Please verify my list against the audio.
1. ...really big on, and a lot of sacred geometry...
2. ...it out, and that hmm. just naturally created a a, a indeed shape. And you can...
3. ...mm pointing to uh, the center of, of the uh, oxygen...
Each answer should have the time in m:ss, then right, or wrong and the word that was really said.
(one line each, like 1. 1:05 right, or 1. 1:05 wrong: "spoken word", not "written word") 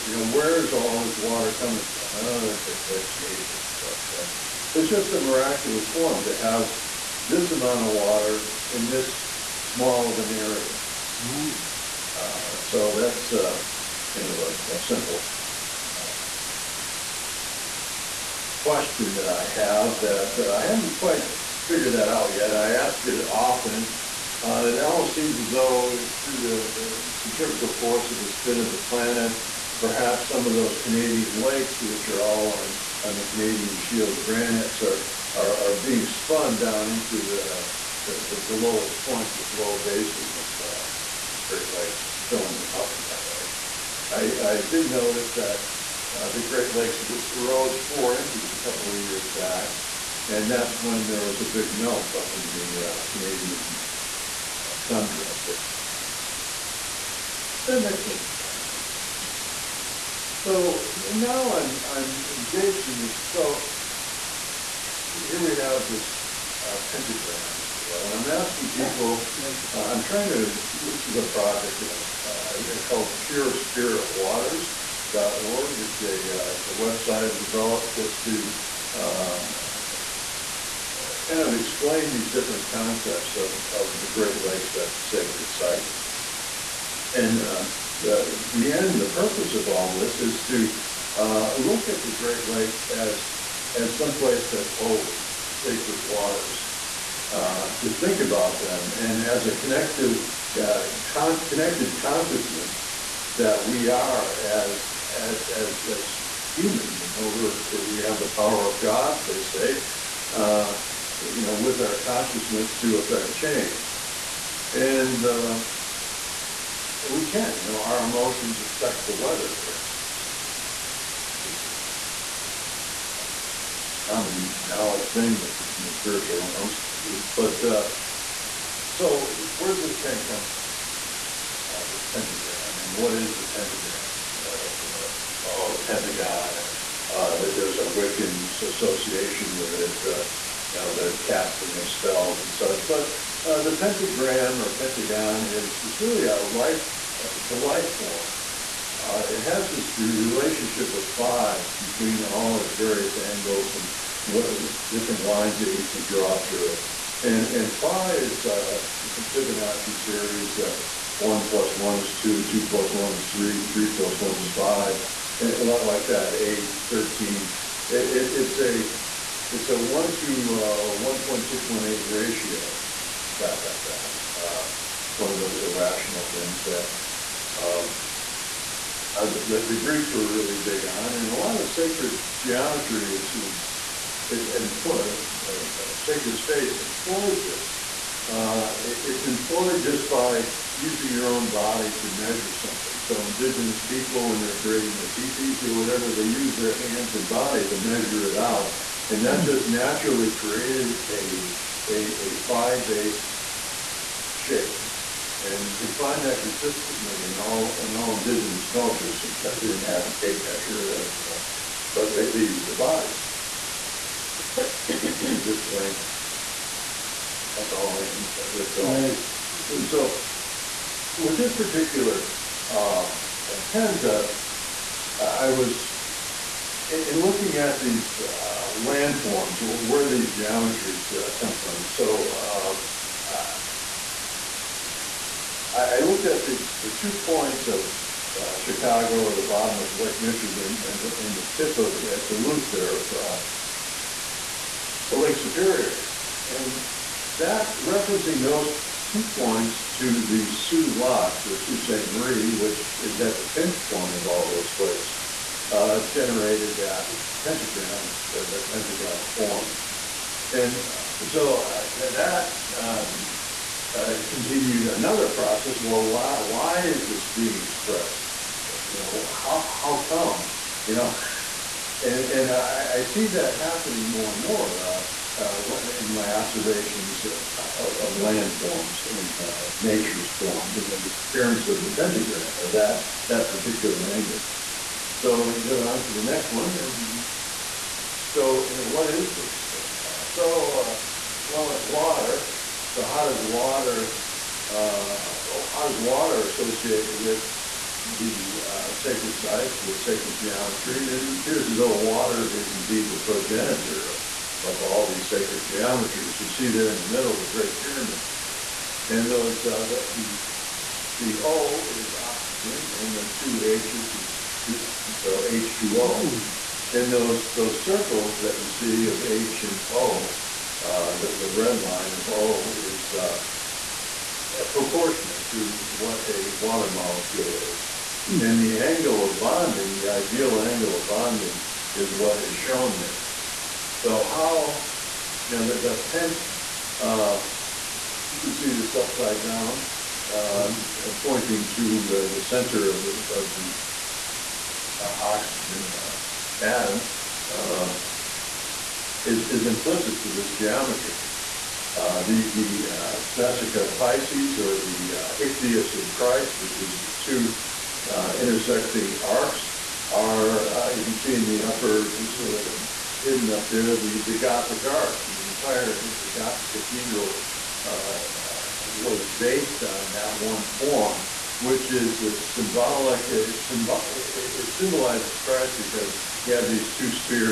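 1. 3:00 right
2. 3:18 wrong: "based", not "indeed"
3. 5:40 right.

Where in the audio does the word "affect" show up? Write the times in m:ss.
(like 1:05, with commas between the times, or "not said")
1:52, 1:58.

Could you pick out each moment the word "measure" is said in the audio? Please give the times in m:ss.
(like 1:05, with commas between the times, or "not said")
3:12, 3:17, 3:30.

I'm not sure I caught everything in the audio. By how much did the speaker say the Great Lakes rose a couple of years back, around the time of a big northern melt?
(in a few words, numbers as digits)
4 inches.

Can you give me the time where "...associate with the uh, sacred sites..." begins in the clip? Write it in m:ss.
4:56.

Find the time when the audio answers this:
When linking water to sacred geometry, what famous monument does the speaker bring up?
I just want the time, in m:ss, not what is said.
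5:07.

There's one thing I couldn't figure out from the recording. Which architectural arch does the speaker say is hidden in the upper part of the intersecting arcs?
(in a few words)
Gothic arch.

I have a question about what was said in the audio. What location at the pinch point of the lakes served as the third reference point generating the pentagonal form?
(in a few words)
Soo Locks.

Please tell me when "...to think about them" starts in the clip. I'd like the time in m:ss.
1:37.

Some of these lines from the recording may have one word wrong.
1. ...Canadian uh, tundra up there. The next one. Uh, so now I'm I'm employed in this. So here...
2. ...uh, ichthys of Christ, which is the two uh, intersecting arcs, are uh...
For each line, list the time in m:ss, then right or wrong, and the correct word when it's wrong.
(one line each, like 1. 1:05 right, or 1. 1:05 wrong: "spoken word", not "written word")
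1. 0:53 wrong: "engaged", not "employed"
2. 5:55 right.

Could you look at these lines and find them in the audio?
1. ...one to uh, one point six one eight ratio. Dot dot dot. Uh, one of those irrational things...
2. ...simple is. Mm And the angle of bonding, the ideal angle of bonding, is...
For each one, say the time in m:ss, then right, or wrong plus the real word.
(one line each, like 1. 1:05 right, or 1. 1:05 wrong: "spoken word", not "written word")
1. 2:49 right
2. 5:26 wrong: "molecule", not "simple".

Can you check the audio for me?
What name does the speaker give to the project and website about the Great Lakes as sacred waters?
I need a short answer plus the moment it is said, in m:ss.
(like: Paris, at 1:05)
Pure Spirit Waters, at 1:13.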